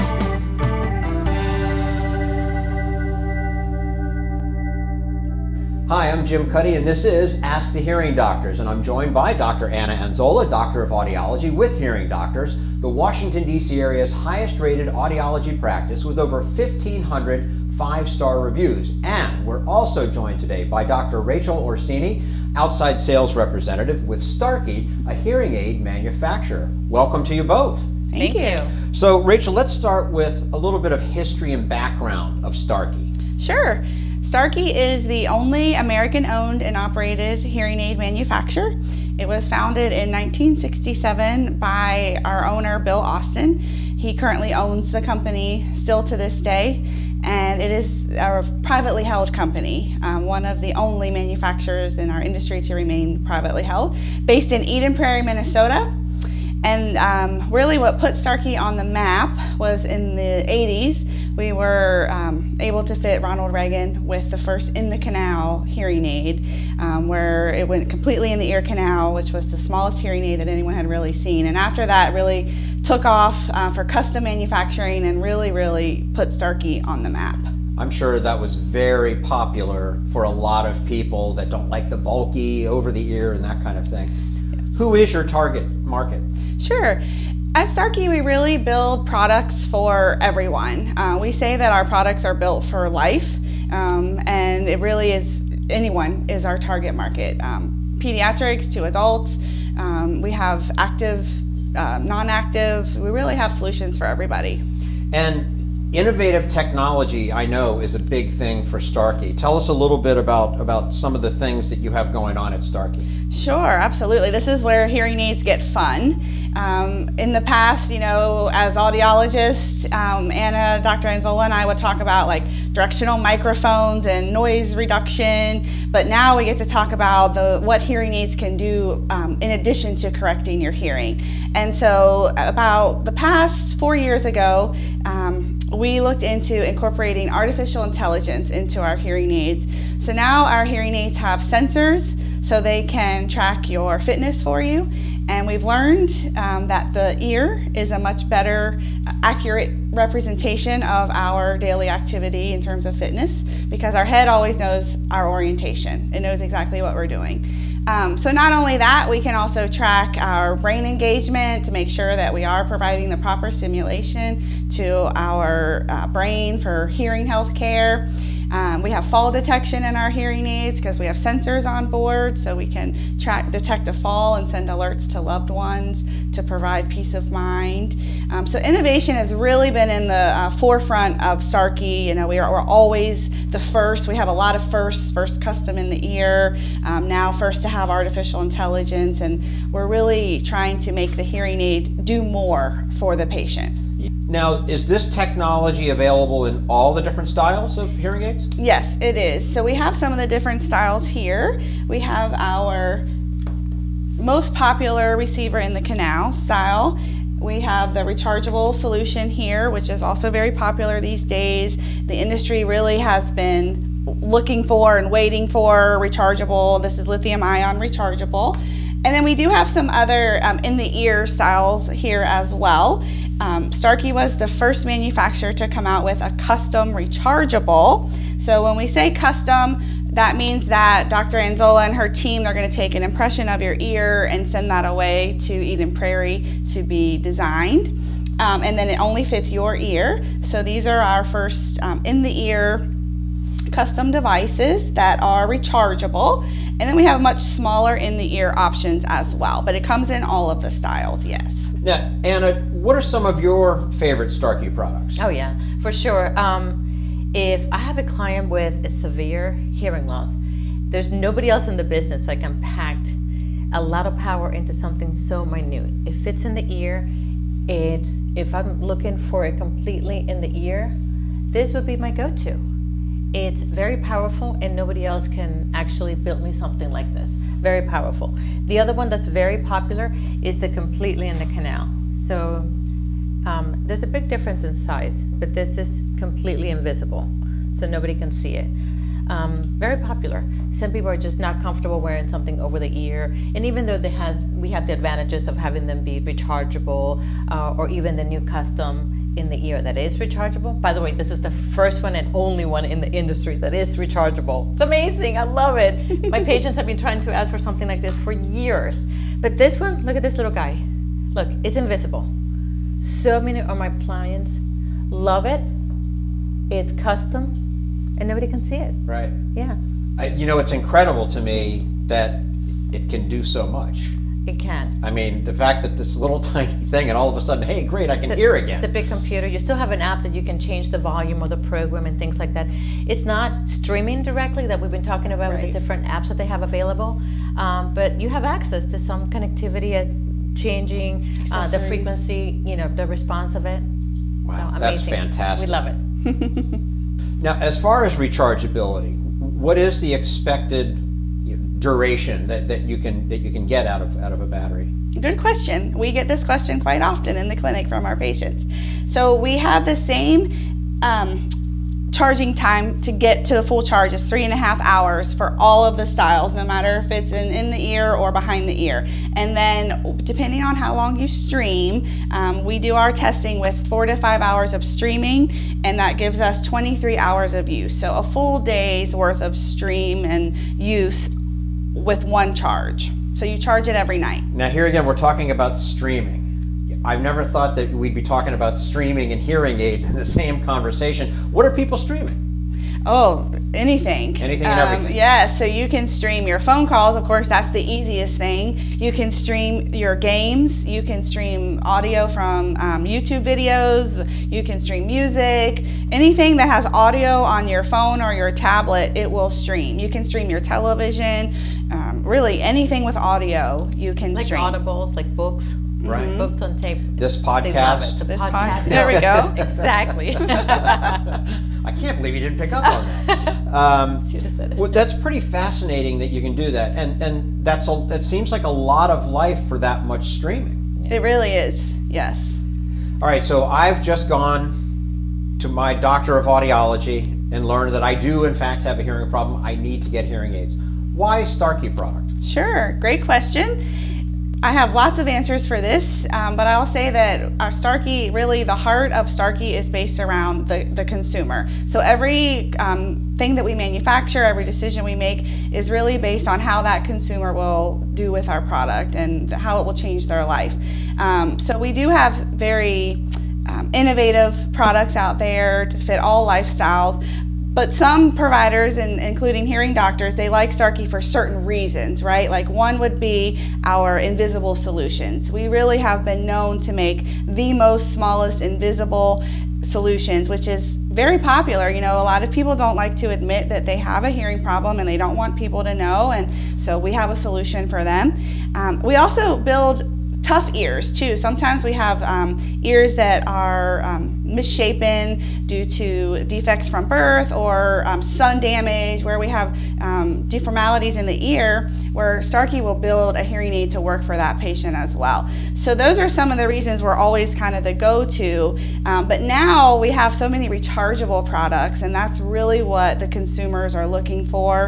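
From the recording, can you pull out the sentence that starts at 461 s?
Um, so we do have very um, innovative products out there to fit all lifestyles.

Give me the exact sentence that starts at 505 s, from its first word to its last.
So those are some of the reasons we're always kind of the go-to.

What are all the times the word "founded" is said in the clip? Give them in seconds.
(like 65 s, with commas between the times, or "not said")
39 s.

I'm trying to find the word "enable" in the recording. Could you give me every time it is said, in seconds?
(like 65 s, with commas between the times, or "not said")
not said.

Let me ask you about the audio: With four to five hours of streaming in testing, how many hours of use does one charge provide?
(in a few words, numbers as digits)
23 hours.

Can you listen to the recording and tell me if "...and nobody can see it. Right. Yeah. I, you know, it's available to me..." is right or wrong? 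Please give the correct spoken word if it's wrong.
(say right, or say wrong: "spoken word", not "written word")
wrong: "incredible", not "available".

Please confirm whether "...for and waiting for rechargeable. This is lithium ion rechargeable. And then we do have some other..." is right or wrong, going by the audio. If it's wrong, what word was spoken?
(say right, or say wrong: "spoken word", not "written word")
right.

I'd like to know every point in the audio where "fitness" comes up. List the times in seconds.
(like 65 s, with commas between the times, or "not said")
143 s, 152 s.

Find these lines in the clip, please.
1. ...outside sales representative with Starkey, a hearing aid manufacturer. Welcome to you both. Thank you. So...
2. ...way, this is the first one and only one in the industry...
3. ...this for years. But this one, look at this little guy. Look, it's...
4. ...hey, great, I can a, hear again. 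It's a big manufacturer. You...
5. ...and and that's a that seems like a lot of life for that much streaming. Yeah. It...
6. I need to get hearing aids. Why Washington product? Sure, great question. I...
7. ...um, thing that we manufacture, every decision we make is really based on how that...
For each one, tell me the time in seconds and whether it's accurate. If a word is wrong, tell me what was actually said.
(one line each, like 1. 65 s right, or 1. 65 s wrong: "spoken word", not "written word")
1. 22 s right
2. 301 s right
3. 308 s right
4. 327 s wrong: "computer", not "manufacturer"
5. 426 s right
6. 439 s wrong: "Starkey", not "Washington"
7. 452 s right.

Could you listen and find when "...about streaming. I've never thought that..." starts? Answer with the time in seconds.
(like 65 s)
385 s.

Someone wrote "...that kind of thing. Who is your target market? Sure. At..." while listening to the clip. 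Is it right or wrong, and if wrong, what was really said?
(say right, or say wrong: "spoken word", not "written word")
right.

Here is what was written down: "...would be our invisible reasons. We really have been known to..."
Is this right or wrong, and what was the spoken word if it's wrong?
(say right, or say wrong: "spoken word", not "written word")
wrong: "solutions", not "reasons".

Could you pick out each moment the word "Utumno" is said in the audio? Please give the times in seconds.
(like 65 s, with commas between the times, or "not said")
not said.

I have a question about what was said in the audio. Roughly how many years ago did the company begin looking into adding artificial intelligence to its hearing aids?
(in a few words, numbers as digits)
4 years.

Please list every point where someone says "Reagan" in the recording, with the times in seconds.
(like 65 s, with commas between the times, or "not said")
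63 s.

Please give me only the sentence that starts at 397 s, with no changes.
Of course, that's the easiest thing.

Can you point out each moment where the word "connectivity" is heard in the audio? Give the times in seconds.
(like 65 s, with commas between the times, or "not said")
339 s.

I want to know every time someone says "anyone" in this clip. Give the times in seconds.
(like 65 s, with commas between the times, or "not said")
70 s, 95 s.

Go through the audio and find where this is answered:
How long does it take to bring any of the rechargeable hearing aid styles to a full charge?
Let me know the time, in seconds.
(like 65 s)
364 s.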